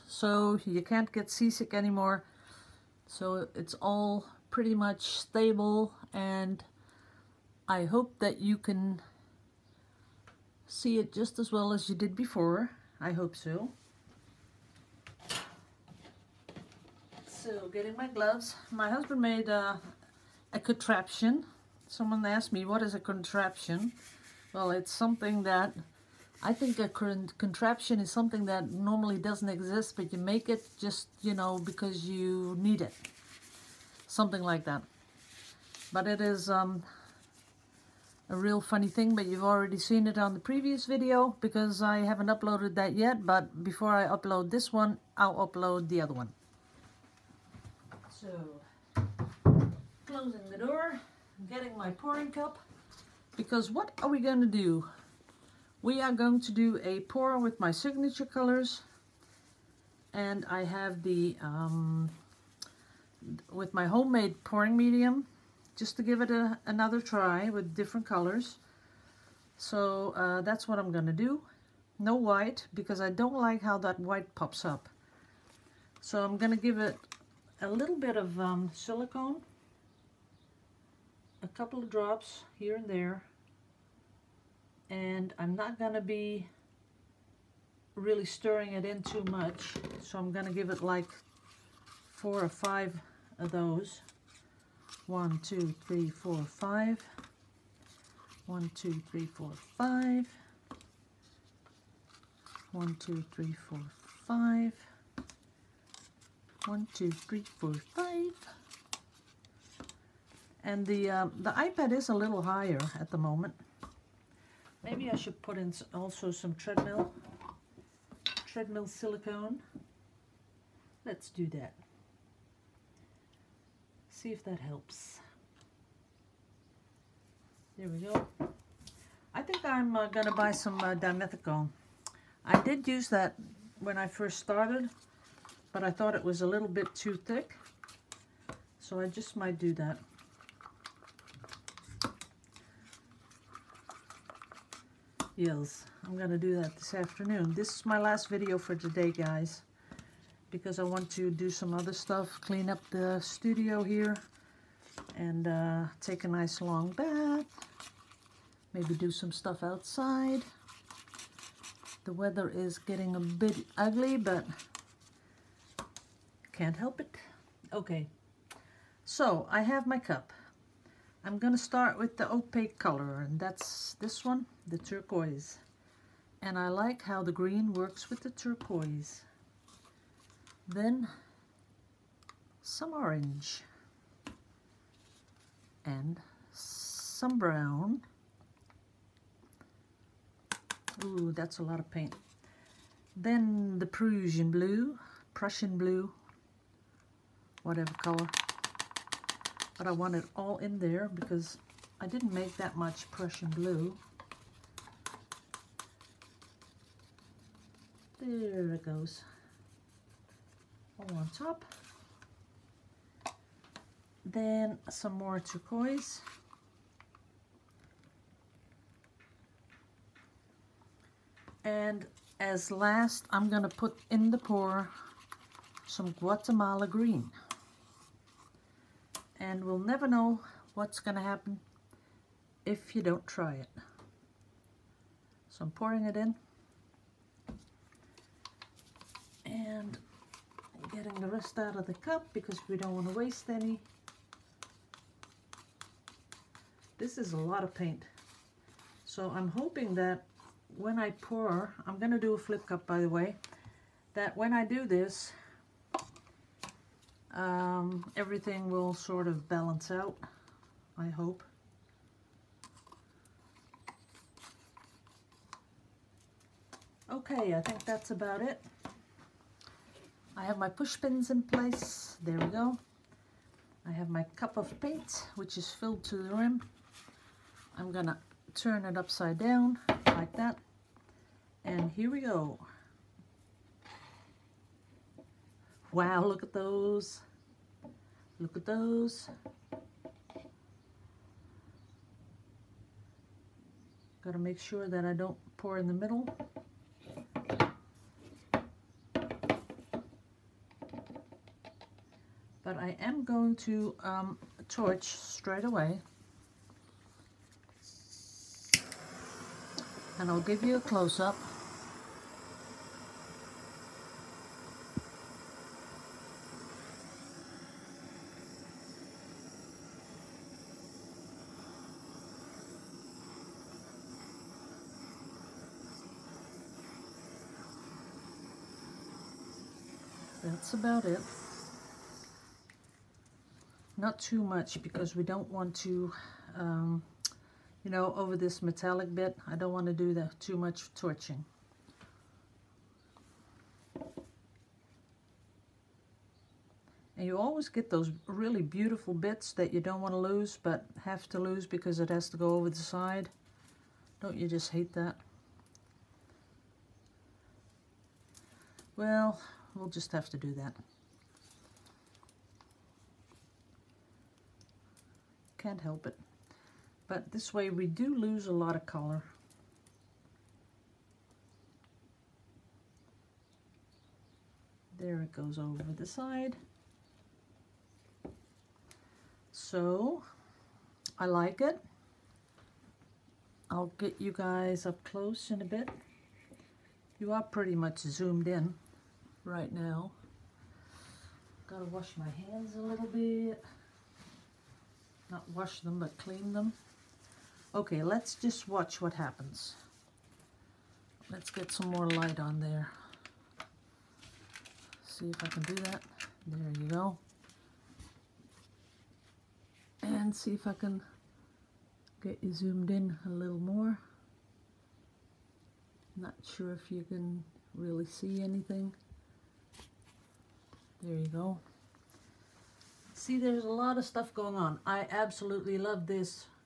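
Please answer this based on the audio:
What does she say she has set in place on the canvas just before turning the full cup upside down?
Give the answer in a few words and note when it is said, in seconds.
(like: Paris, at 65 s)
push pins, at 270 s.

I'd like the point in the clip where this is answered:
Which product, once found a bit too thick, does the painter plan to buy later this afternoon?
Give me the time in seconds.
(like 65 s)
130 s.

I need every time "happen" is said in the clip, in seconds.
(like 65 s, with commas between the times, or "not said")
231 s, 399 s.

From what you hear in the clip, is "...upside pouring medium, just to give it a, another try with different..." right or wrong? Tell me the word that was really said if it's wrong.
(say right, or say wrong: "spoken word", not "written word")
wrong: "homemade", not "upside".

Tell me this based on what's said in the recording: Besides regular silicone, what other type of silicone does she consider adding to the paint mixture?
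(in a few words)
treadmill silicone.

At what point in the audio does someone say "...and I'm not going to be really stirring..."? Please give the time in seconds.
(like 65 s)
84 s.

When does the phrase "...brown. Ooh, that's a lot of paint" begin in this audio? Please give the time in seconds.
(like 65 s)
187 s.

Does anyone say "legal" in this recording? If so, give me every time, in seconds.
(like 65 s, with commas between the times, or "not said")
not said.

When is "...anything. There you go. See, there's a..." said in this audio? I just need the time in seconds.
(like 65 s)
418 s.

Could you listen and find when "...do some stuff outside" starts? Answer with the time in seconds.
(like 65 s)
158 s.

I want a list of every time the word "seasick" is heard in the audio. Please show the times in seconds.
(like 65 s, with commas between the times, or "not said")
1 s.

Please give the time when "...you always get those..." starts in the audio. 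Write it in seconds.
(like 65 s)
347 s.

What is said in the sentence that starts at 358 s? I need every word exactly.
Well, we'll just have to do that.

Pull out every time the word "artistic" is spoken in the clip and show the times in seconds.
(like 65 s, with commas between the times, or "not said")
not said.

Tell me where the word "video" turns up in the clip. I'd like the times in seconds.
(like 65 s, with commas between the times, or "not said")
40 s, 148 s.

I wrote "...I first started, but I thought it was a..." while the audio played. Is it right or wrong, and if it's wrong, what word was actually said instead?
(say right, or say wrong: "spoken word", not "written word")
right.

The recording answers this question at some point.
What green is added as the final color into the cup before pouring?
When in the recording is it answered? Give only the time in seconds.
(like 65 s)
226 s.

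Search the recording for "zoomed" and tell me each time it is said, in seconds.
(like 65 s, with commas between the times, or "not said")
387 s, 412 s.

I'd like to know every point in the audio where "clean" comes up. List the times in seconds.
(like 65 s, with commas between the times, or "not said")
152 s, 396 s.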